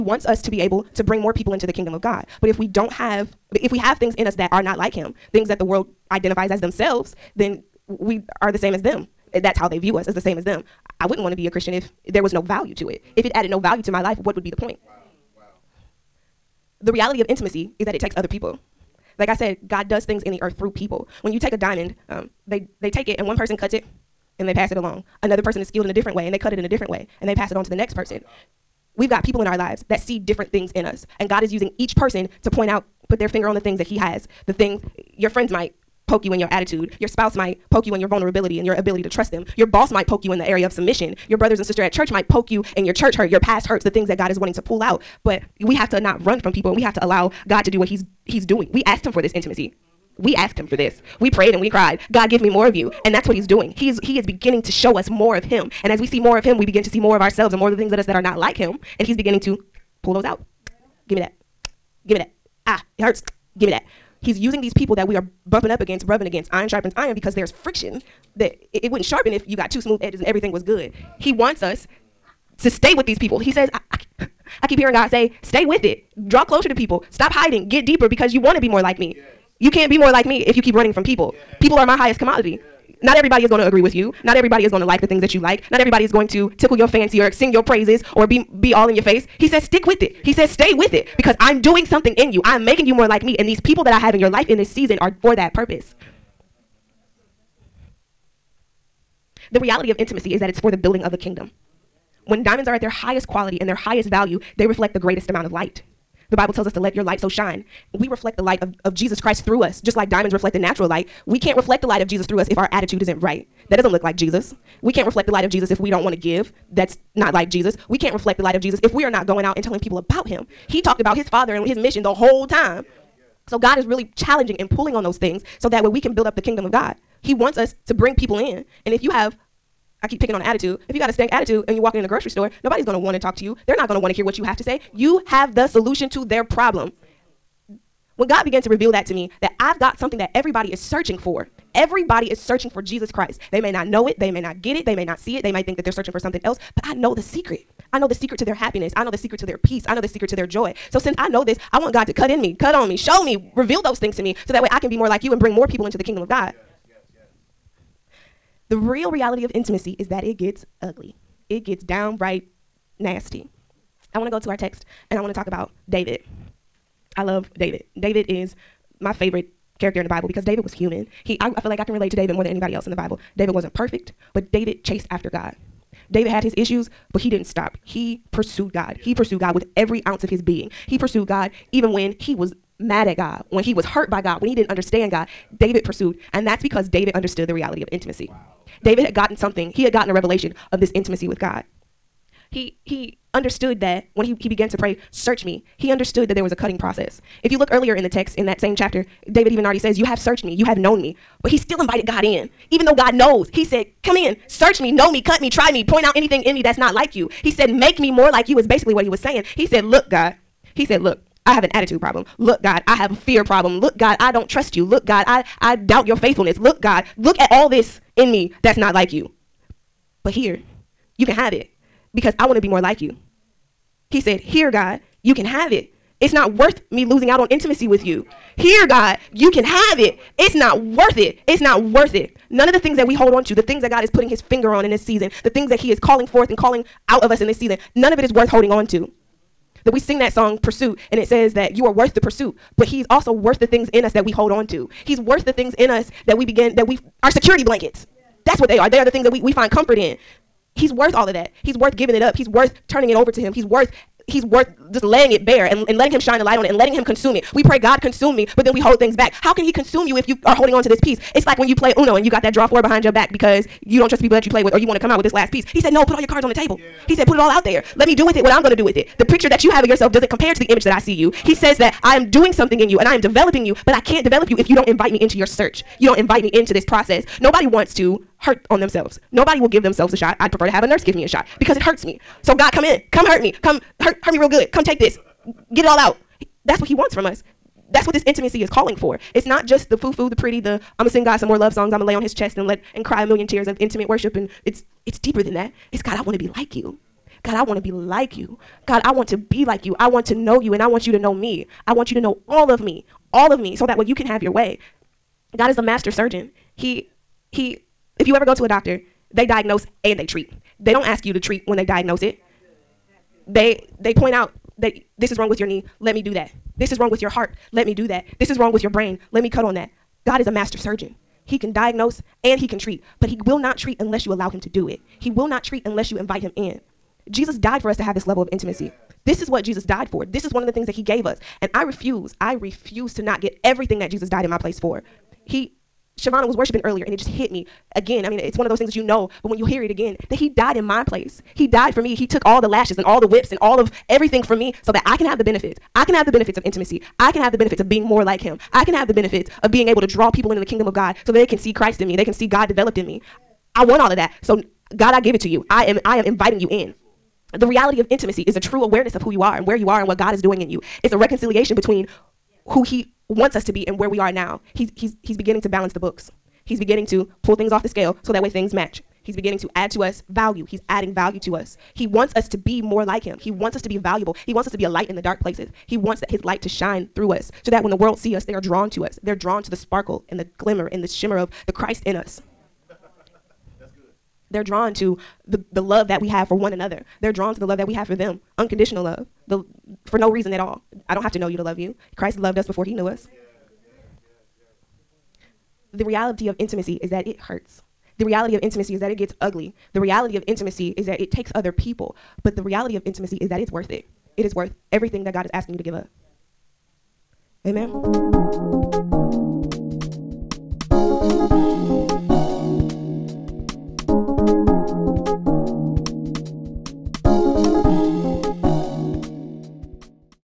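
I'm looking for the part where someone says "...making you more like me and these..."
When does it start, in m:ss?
1:32.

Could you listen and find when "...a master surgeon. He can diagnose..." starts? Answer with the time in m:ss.
5:20.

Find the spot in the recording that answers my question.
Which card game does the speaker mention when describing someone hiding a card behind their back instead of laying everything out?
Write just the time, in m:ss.
4:21.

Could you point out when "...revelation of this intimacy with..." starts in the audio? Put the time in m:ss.
3:10.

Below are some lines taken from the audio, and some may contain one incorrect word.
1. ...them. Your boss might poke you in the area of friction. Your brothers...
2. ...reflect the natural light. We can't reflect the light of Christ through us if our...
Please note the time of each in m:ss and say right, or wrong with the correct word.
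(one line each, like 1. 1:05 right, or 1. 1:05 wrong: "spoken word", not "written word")
1. 0:39 wrong: "submission", not "friction"
2. 1:50 wrong: "Jesus", not "Christ".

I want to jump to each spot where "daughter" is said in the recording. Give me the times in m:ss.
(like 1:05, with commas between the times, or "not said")
not said.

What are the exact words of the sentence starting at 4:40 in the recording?
I'd prefer to have a nurse give me a shot because it hurts me.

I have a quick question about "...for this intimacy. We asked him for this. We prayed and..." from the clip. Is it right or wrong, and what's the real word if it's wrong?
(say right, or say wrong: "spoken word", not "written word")
right.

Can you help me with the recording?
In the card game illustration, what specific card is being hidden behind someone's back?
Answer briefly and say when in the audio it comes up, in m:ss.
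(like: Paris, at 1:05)
draw four, at 4:22.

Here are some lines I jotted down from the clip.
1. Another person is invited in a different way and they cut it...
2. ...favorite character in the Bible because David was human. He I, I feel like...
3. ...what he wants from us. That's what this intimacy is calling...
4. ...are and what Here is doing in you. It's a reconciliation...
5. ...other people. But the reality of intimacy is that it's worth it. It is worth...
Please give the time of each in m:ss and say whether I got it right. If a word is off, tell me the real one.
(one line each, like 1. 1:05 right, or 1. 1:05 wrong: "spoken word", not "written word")
1. 0:25 wrong: "skilled", not "invited"
2. 2:49 right
3. 4:46 right
4. 5:59 wrong: "God", not "Here"
5. 6:41 right.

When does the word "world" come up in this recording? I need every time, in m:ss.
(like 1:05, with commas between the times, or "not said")
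0:05, 6:17.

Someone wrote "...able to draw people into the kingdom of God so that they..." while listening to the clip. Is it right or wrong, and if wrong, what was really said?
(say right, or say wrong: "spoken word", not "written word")
right.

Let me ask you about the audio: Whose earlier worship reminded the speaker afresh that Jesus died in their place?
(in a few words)
Shavana.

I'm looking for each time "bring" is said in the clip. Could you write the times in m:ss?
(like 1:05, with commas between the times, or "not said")
0:01, 2:07, 2:35.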